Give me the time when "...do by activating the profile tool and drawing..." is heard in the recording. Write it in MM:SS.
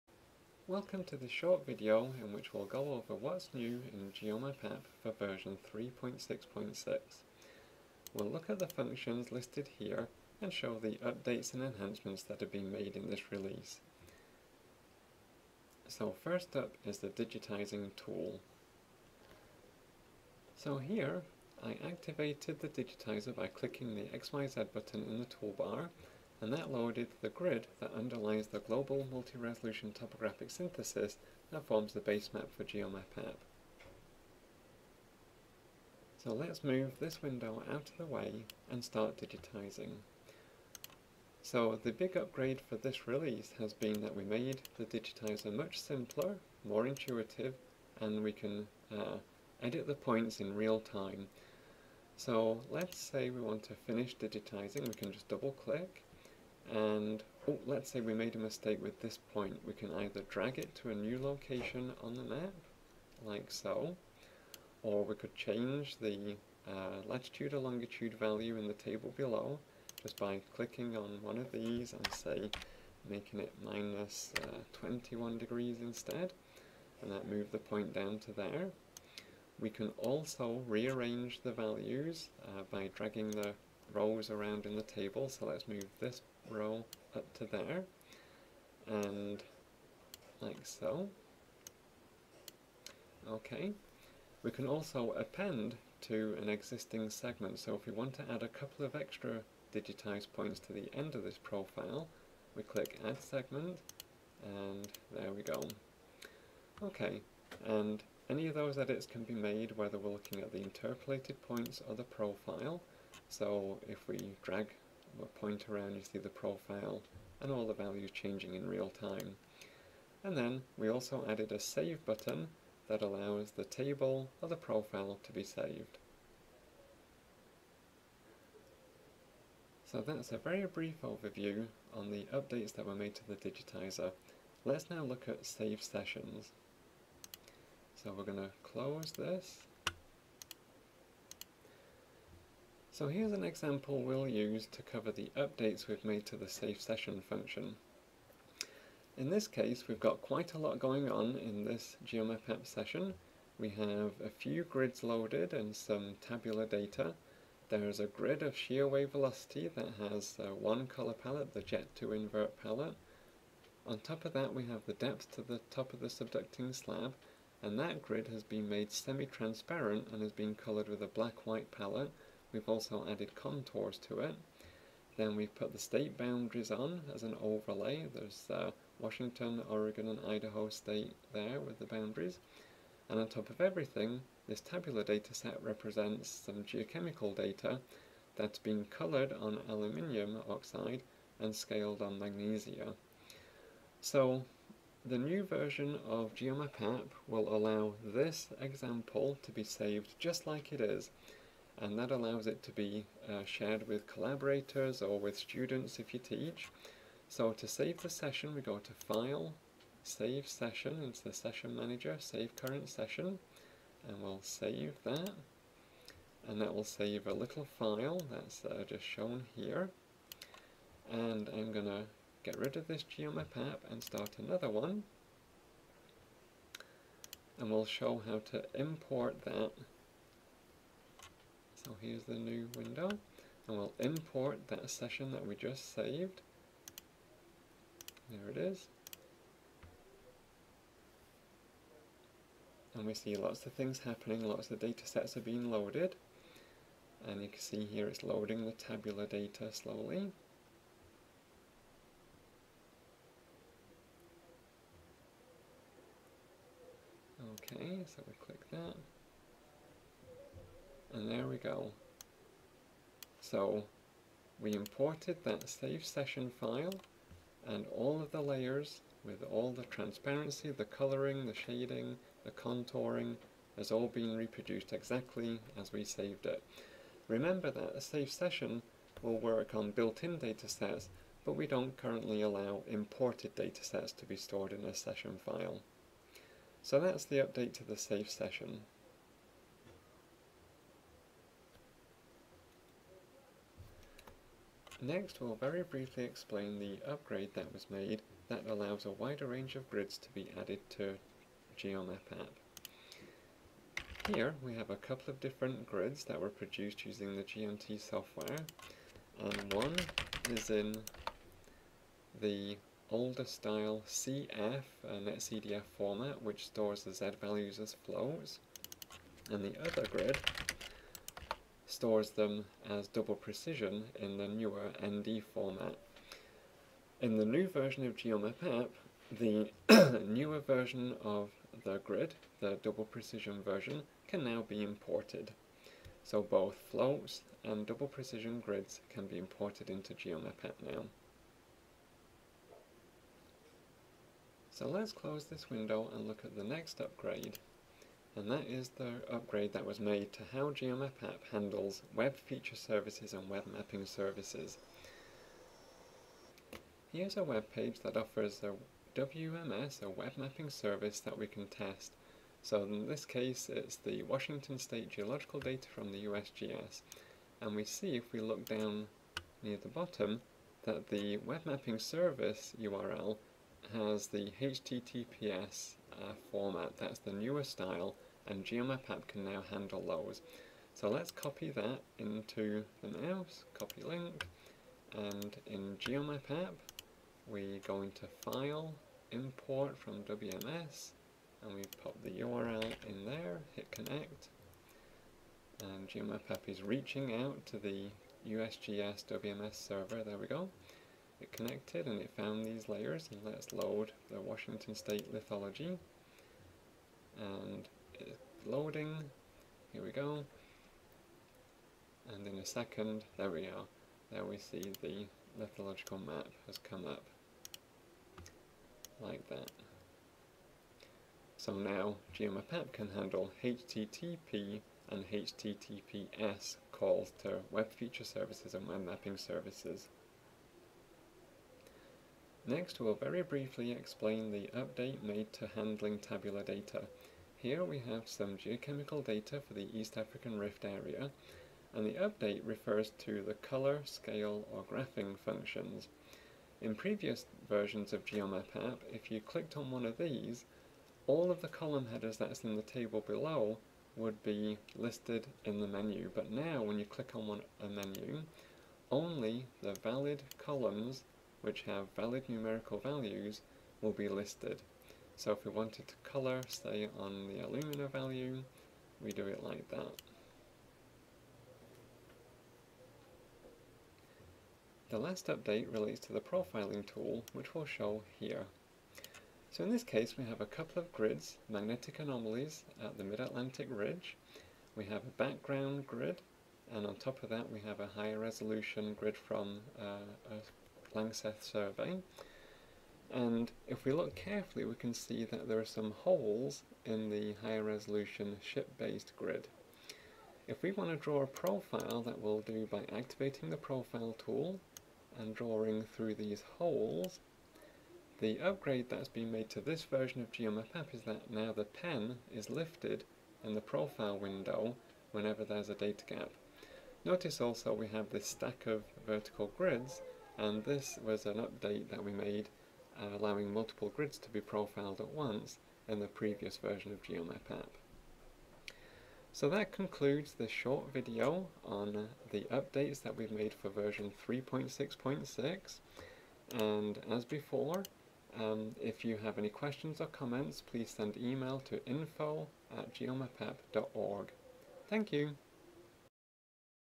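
08:22.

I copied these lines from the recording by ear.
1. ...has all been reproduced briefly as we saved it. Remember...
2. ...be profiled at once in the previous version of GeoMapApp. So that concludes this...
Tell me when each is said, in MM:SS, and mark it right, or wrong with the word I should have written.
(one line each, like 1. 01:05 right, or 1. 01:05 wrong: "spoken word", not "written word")
1. 04:33 wrong: "exactly", not "briefly"
2. 08:44 right.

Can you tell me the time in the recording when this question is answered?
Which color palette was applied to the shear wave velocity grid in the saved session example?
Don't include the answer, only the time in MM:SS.
02:41.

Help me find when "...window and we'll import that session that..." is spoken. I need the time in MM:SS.
03:52.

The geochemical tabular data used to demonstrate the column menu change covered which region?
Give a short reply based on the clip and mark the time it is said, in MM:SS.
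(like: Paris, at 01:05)
East African Rift, at 07:19.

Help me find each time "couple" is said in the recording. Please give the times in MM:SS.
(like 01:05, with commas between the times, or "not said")
01:38, 05:04, 08:00.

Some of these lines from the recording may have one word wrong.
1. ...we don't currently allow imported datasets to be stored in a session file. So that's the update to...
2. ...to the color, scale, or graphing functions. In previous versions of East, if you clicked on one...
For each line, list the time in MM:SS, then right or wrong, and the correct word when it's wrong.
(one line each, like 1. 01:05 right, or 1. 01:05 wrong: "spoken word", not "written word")
1. 04:41 right
2. 07:23 wrong: "GeoMapApp", not "East".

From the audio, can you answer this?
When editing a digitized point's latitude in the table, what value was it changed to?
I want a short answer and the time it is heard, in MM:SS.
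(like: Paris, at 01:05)
-21 degrees, at 01:13.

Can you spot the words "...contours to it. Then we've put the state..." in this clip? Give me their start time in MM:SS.
02:53.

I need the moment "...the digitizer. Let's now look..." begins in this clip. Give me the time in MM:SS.
02:13.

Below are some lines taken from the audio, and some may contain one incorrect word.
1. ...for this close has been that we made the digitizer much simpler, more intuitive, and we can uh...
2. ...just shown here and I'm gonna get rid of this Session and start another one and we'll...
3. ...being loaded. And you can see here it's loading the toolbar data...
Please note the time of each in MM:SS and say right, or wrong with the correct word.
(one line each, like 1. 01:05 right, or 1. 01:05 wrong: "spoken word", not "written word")
1. 00:42 wrong: "release", not "close"
2. 03:38 wrong: "GeoMapApp", not "Session"
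3. 04:05 wrong: "tabular", not "toolbar".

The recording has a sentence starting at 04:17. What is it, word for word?
Okay, so we click that and there we go.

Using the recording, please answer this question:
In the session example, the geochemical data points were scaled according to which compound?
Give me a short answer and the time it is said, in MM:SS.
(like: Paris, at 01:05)
magnesia, at 03:12.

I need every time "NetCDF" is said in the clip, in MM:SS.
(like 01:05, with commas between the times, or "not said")
05:15.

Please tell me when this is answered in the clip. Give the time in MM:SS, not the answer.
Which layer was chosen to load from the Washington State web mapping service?
06:44.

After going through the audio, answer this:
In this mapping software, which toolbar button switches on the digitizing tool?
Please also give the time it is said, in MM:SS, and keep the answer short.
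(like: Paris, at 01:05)
XYZ, at 00:24.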